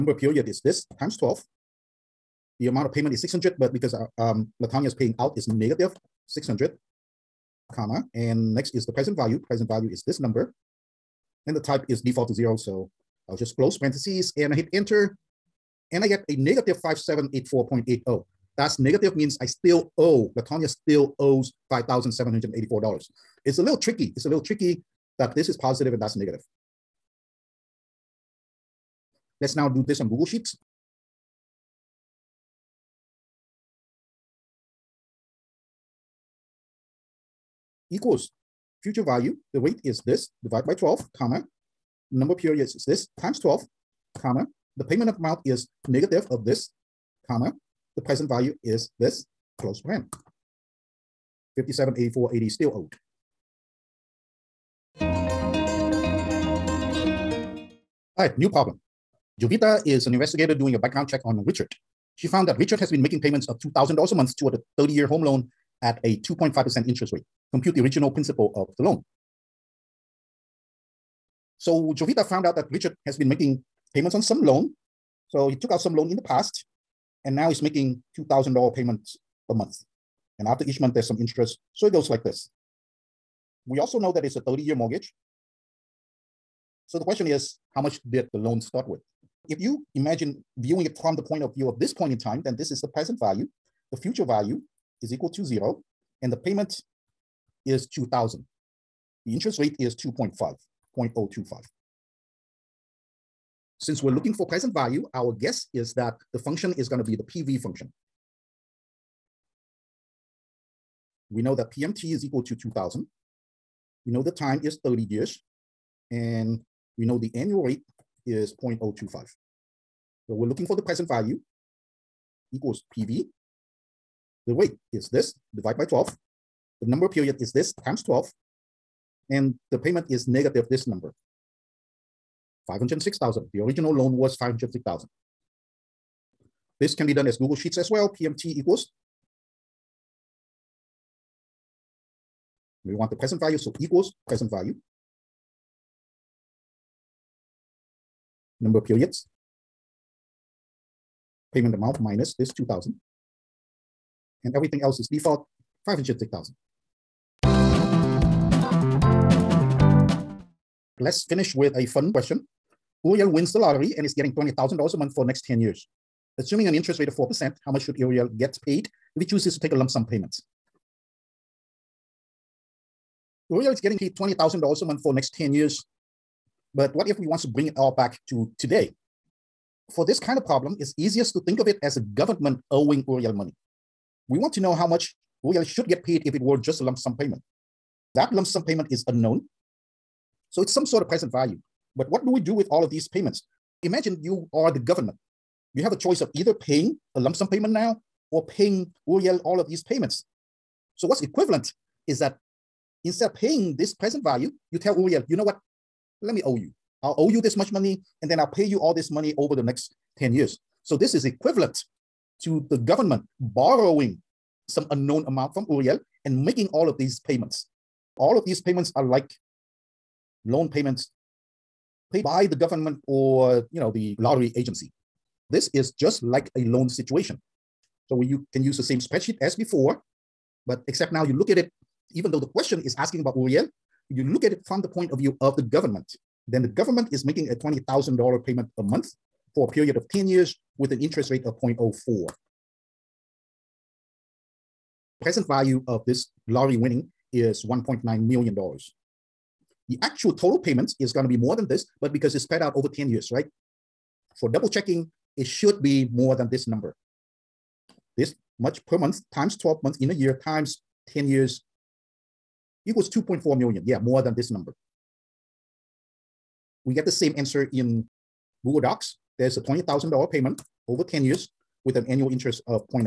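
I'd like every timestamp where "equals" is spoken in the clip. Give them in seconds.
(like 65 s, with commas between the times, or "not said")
37 s, 95 s, 112 s, 122 s, 138 s, 143 s, 262 s.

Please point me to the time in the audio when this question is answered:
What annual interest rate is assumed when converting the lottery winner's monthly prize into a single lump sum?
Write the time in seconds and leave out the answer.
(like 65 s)
167 s.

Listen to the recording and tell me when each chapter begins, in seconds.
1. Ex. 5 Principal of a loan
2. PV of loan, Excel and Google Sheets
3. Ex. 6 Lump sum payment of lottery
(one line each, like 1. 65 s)
1. 55 s
2. 108 s
3. 157 s.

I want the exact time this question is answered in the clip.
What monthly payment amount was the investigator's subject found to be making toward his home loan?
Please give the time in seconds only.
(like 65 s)
63 s.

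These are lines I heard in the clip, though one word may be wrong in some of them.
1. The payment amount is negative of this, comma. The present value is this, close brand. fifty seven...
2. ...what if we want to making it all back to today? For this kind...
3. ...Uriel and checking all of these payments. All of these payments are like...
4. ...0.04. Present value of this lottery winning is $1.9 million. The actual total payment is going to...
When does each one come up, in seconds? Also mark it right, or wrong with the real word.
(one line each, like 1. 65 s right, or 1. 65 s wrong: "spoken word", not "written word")
1. 44 s right
2. 176 s wrong: "bring", not "making"
3. 215 s wrong: "making", not "checking"
4. 241 s right.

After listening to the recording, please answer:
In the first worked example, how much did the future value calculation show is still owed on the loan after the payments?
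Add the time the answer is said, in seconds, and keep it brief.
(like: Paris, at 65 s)
$5,784.80, at 16 s.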